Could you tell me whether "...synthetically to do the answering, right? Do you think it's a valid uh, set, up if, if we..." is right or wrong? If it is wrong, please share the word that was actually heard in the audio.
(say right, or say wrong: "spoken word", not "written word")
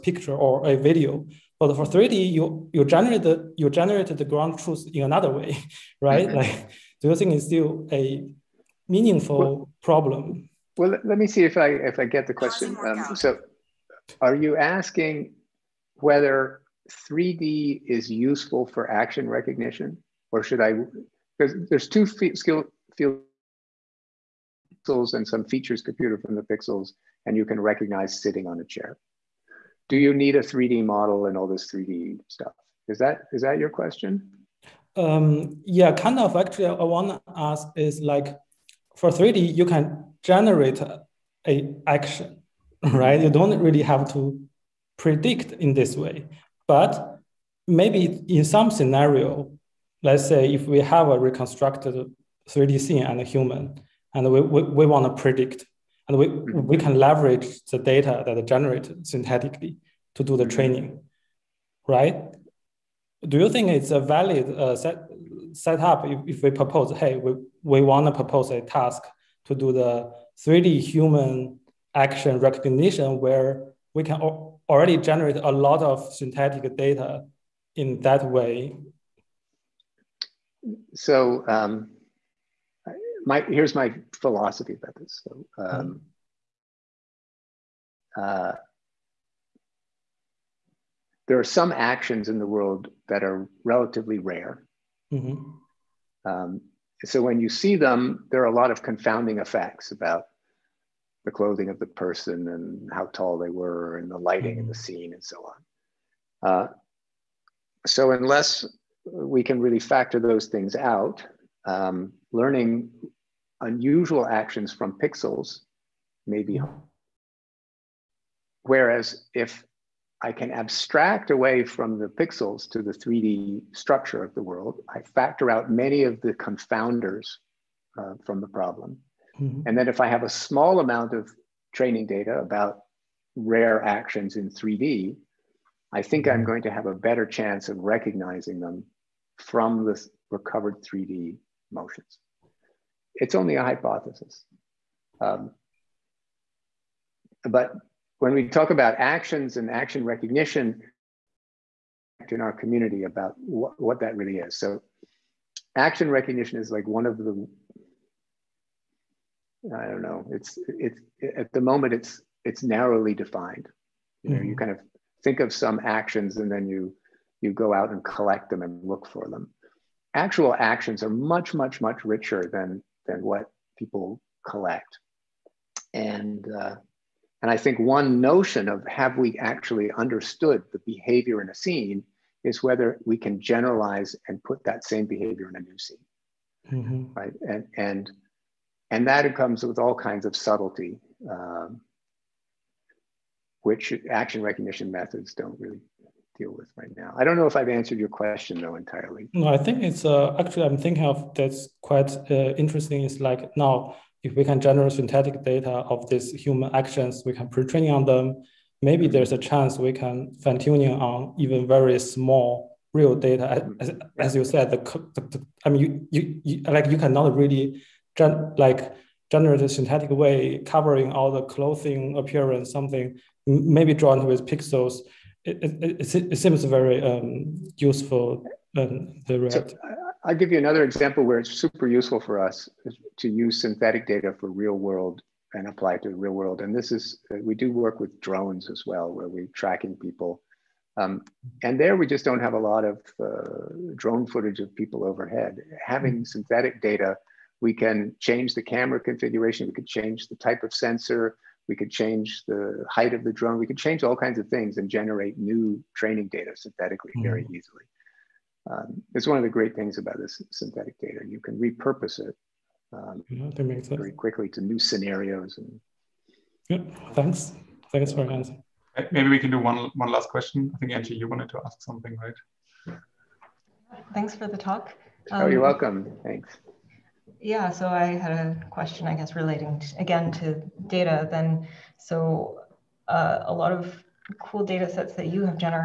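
wrong: "training", not "answering".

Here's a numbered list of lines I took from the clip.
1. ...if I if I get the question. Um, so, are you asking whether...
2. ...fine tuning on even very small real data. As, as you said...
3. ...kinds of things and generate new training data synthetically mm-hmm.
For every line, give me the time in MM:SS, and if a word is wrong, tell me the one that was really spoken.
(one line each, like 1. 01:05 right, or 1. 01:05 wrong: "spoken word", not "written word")
1. 00:11 right
2. 03:30 right
3. 04:14 right.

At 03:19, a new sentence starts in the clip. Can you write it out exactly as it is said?
No, I think it's uh, actually I'm thinking of that's quite uh, interesting.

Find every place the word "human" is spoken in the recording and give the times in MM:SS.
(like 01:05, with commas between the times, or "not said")
00:53, 01:10, 03:26.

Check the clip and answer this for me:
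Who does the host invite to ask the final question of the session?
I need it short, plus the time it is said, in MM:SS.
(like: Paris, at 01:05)
Angie, at 04:30.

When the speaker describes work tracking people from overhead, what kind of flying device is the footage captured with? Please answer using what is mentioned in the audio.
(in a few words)
drones.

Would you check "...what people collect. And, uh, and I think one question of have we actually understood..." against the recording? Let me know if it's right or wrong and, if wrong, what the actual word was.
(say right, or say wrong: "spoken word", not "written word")
wrong: "notion", not "question".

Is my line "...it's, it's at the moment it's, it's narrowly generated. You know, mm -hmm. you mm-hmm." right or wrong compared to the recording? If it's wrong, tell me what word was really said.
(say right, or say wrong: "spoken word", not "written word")
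wrong: "defined", not "generated".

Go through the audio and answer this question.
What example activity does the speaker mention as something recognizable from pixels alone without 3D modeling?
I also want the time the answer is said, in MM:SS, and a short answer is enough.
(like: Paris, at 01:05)
sitting on a chair, at 00:28.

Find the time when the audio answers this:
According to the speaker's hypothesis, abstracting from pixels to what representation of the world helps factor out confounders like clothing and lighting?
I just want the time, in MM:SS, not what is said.
02:02.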